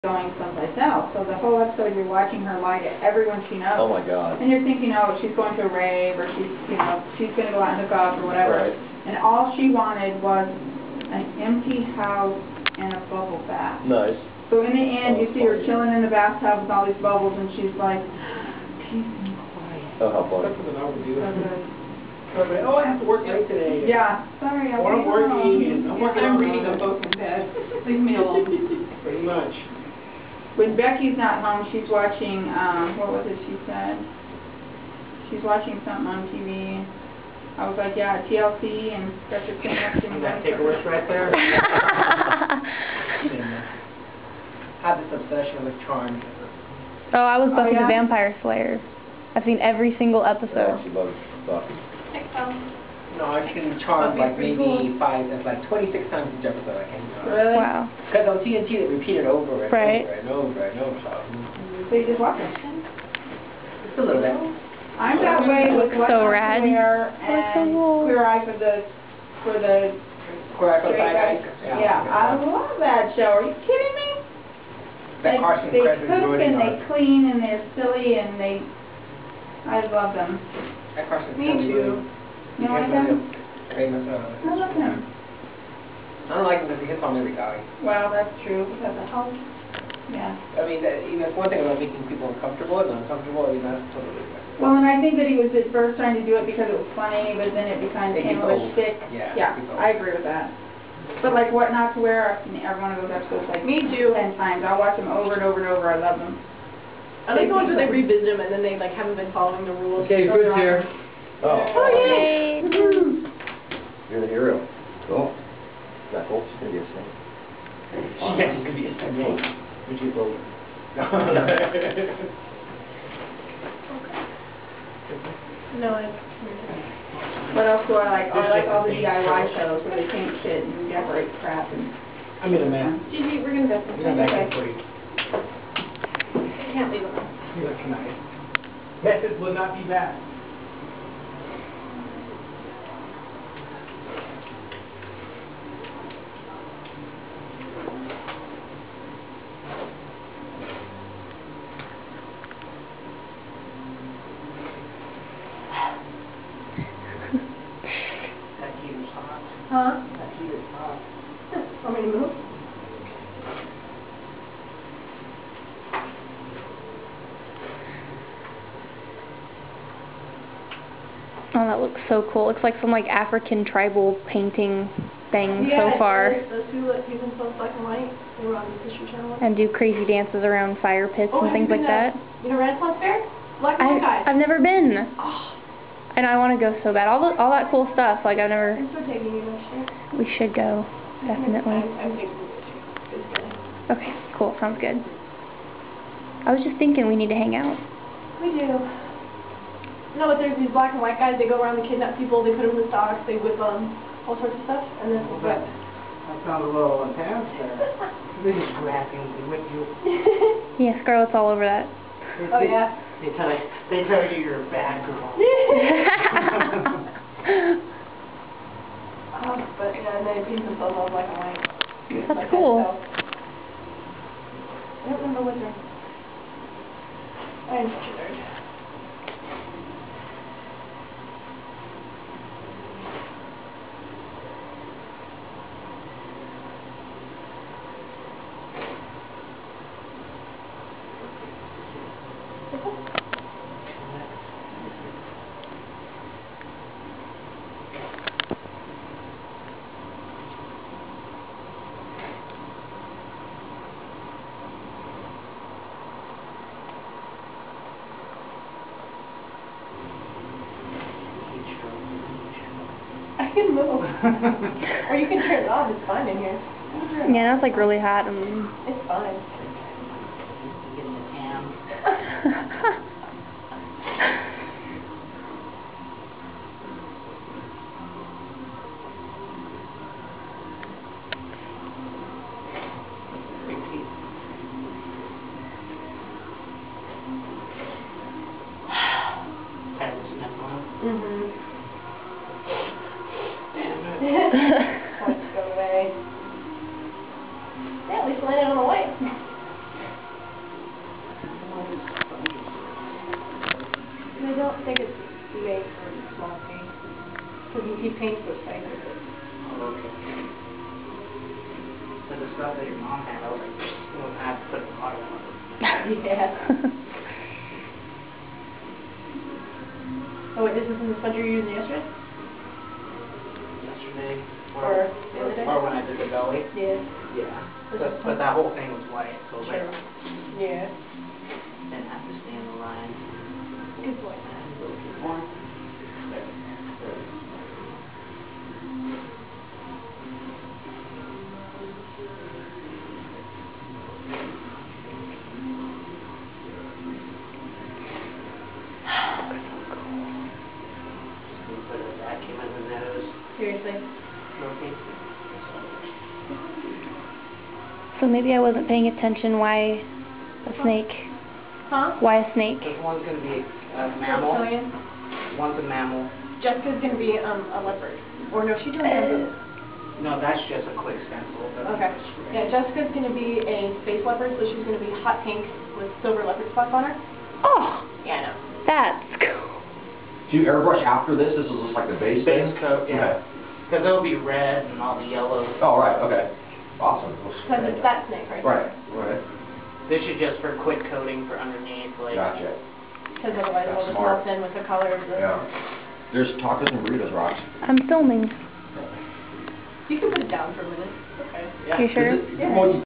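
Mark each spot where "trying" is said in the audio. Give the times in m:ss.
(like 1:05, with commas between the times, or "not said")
1:35.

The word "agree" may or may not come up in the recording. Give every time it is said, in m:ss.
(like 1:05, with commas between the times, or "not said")
1:39.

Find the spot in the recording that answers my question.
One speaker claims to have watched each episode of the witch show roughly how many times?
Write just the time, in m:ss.
0:55.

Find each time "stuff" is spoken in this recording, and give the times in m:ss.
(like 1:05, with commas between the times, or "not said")
3:07, 3:24, 5:12.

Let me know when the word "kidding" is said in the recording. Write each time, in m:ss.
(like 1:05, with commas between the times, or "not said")
1:13.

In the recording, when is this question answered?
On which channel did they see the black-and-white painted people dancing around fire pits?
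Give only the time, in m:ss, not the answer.
2:58.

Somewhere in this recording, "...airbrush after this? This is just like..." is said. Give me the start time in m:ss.
6:20.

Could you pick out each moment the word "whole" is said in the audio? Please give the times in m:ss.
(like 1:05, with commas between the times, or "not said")
0:01, 5:28.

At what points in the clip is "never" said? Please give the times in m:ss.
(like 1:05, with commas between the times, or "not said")
3:04, 3:08.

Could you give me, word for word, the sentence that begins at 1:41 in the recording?
But like What Not to Wear, I mean, everyone goes up to us like.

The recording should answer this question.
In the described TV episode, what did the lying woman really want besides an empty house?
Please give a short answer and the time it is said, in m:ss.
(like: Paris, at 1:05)
A bubble bath, at 0:12.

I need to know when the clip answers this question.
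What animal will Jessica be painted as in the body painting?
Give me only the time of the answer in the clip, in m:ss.
6:14.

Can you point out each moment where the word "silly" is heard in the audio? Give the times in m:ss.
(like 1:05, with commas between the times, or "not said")
1:17.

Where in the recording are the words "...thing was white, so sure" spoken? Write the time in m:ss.
5:28.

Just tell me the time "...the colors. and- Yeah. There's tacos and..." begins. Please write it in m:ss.
6:34.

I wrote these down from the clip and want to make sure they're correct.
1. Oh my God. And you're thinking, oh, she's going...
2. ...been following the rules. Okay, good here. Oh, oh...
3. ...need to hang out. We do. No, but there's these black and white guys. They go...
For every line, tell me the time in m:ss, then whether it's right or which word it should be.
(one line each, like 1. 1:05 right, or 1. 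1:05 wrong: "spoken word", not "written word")
1. 0:03 right
2. 1:49 right
3. 3:17 right.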